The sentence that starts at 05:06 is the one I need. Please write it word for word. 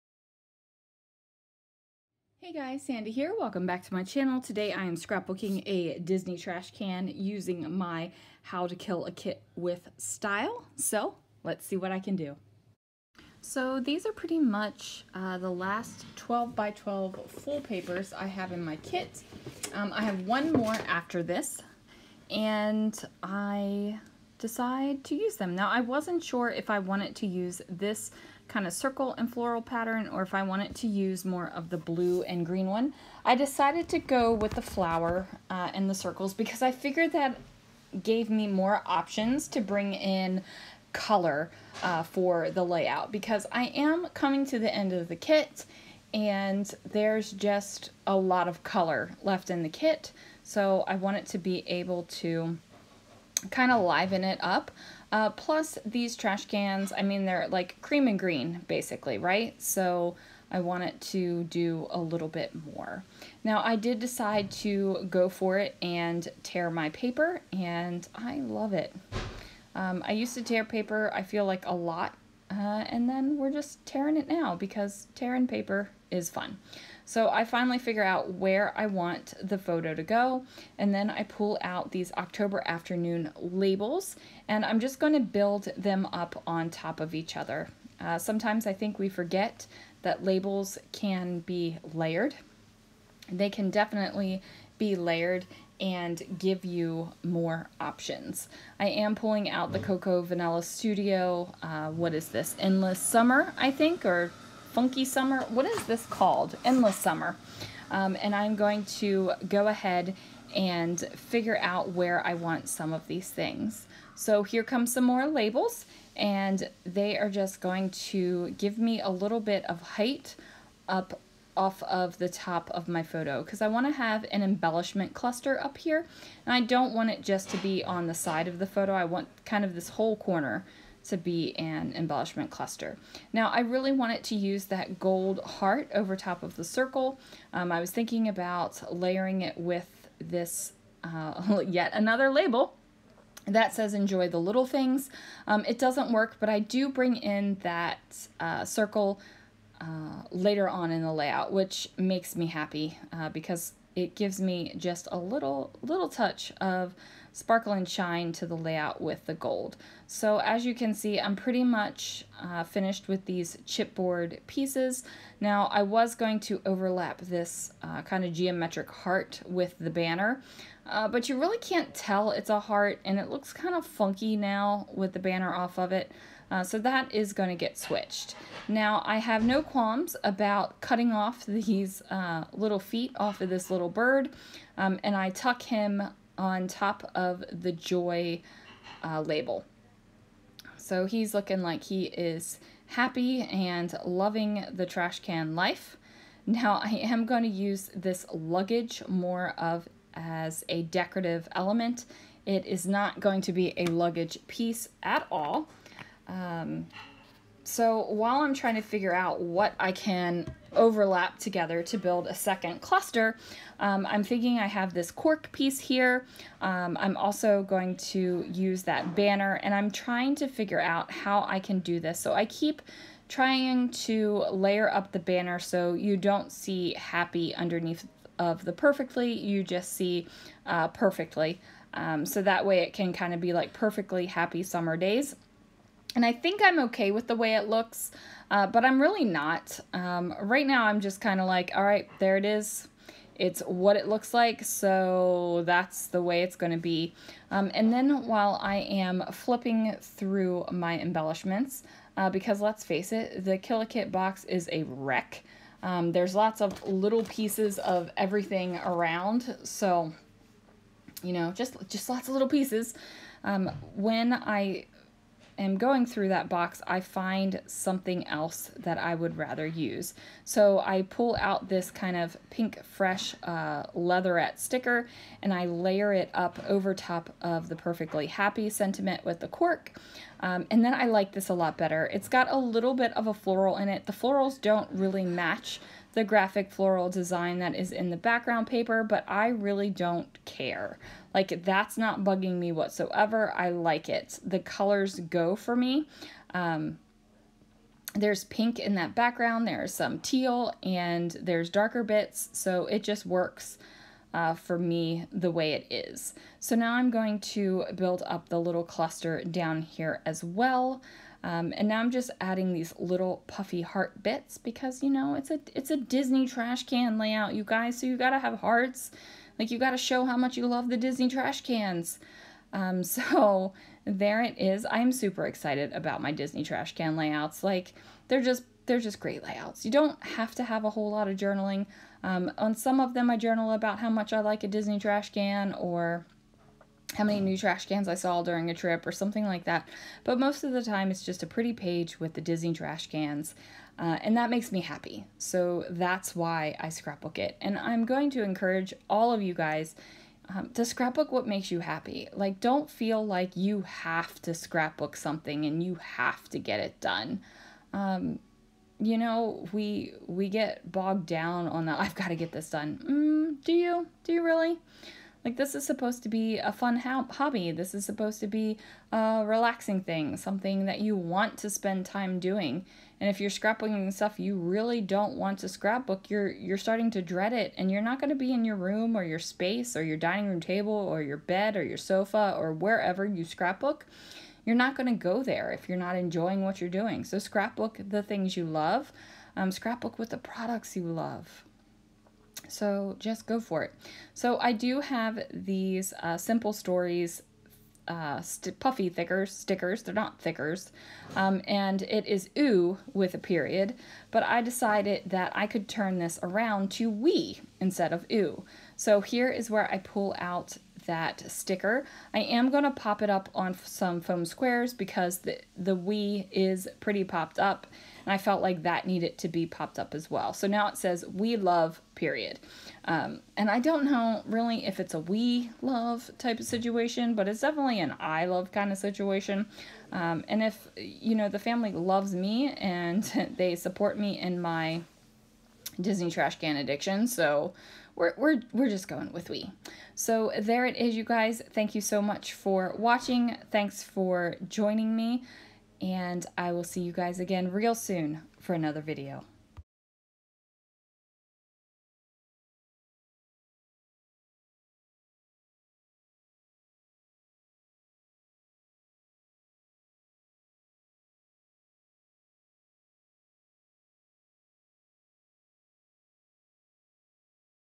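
So now I'm going to build up the little cluster down here as well.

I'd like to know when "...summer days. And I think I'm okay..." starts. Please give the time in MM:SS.
03:54.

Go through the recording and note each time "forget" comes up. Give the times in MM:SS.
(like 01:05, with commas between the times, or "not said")
01:29.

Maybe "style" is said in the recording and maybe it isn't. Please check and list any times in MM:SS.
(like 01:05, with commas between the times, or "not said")
00:09.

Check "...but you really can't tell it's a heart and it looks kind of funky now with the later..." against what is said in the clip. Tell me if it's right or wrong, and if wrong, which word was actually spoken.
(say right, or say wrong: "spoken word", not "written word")
wrong: "banner", not "later".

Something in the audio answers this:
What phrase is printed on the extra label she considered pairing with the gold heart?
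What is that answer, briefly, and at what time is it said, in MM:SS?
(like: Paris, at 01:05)
enjoy the little things, at 02:23.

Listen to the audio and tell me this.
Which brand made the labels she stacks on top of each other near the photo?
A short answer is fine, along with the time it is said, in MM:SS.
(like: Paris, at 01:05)
October Afternoon, at 01:22.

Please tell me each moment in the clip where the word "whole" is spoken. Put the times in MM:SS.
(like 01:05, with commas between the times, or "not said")
02:09, 05:30.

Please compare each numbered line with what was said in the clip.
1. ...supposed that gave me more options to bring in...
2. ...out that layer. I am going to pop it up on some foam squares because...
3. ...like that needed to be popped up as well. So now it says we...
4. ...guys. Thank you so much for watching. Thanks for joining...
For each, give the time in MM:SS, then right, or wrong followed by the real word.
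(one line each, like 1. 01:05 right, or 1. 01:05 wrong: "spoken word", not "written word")
1. 00:36 wrong: "figured", not "supposed"
2. 06:50 wrong: "sticker", not "layer"
3. 06:58 right
4. 07:21 right.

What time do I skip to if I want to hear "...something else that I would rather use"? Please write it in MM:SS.
04:27.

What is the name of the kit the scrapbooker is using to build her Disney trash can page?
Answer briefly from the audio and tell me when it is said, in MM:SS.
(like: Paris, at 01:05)
How to Kill a Kit, at 00:08.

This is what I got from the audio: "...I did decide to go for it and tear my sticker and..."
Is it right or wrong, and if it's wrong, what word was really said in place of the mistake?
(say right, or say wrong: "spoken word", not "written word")
wrong: "paper", not "sticker".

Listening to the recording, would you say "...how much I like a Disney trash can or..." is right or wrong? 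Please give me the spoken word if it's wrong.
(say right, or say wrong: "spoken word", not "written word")
right.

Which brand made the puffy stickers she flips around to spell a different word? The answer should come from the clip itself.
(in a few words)
Simple Stories.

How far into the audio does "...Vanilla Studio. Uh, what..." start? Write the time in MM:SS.
01:40.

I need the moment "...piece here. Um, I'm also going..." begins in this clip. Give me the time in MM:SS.
03:35.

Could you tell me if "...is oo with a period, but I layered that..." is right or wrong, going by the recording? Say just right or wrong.
wrong.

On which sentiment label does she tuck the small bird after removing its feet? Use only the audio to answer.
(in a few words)
joy.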